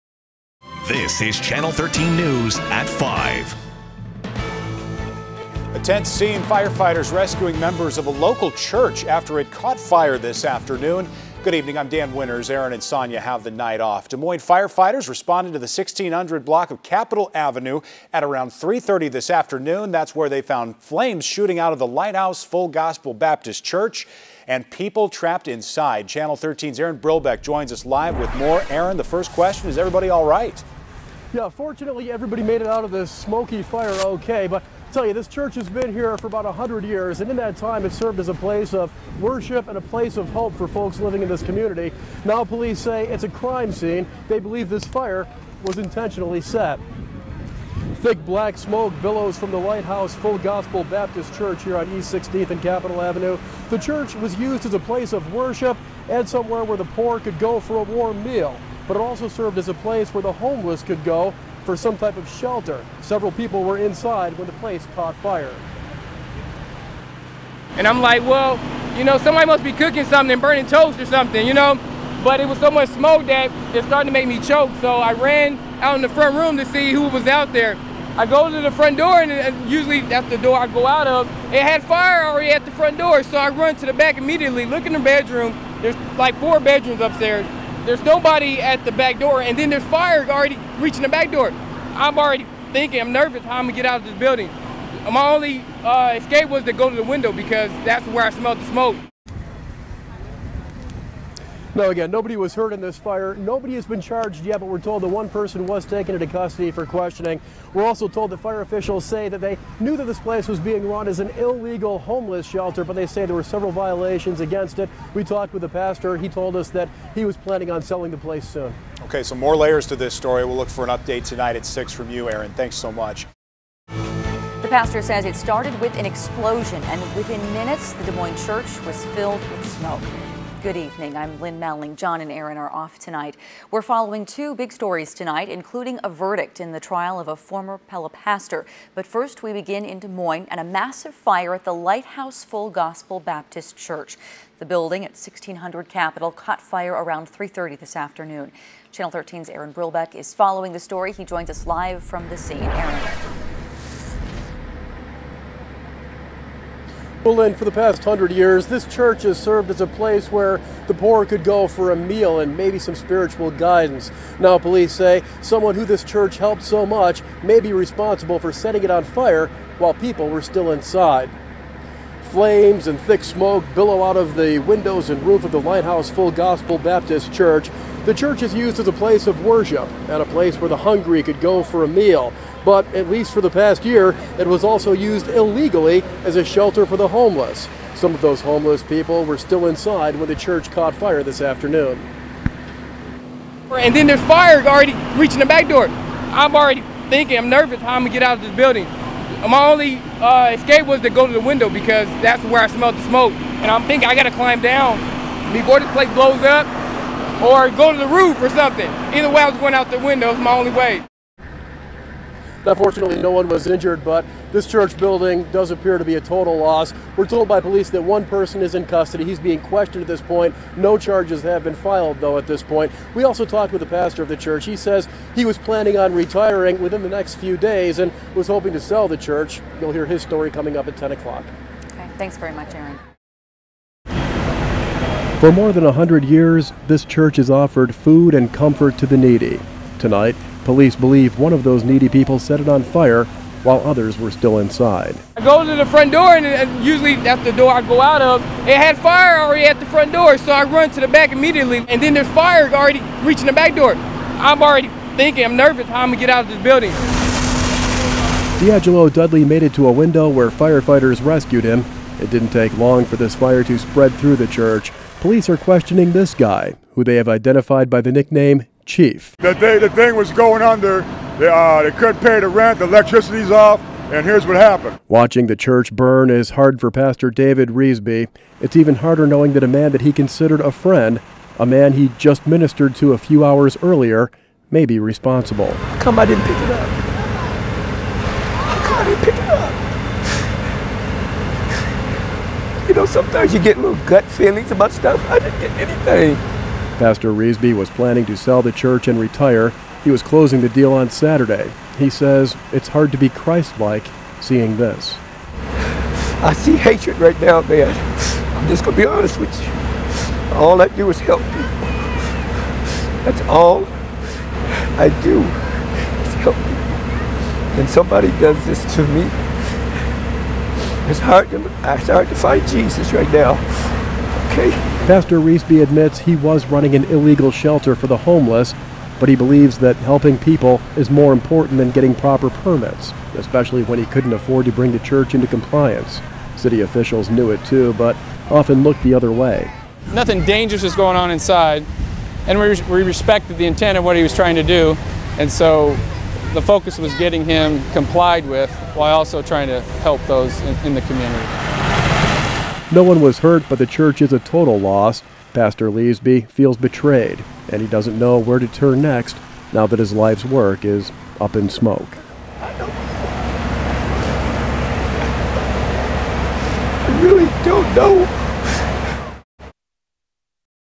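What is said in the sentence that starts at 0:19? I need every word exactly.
That's where they found flames shooting out of the Lighthouse Full Gospel Baptist Church and people trapped inside.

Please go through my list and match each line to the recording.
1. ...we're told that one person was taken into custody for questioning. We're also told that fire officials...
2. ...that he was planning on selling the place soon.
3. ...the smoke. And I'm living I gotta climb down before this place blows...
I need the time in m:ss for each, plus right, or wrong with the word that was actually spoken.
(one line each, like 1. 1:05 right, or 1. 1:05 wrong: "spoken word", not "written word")
1. 1:44 right
2. 1:56 right
3. 3:22 wrong: "thinking", not "living".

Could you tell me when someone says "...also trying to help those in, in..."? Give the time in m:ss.
5:49.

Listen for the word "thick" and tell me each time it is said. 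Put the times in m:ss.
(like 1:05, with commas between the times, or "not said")
0:48, 2:53.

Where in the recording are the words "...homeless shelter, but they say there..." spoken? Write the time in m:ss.
1:51.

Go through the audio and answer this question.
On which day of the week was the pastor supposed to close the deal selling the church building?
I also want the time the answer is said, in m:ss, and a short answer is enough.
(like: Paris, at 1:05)
Saturday, at 5:01.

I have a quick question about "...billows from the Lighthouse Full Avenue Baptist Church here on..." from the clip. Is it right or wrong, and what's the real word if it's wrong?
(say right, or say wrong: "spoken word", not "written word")
wrong: "Gospel", not "Avenue".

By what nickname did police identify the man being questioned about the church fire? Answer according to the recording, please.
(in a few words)
Chief.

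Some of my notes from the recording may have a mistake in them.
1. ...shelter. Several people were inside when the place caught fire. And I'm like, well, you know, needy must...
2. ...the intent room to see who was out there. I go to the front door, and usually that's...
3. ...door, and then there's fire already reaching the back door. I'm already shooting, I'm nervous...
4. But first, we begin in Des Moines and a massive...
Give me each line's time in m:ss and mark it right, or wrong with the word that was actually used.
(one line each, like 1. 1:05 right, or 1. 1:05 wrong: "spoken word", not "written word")
1. 1:02 wrong: "somebody", not "needy"
2. 1:16 wrong: "front", not "intent"
3. 1:29 wrong: "thinking", not "shooting"
4. 2:18 right.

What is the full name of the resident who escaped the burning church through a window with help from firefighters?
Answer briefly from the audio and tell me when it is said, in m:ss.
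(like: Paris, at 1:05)
D'Angelo Dudley, at 4:18.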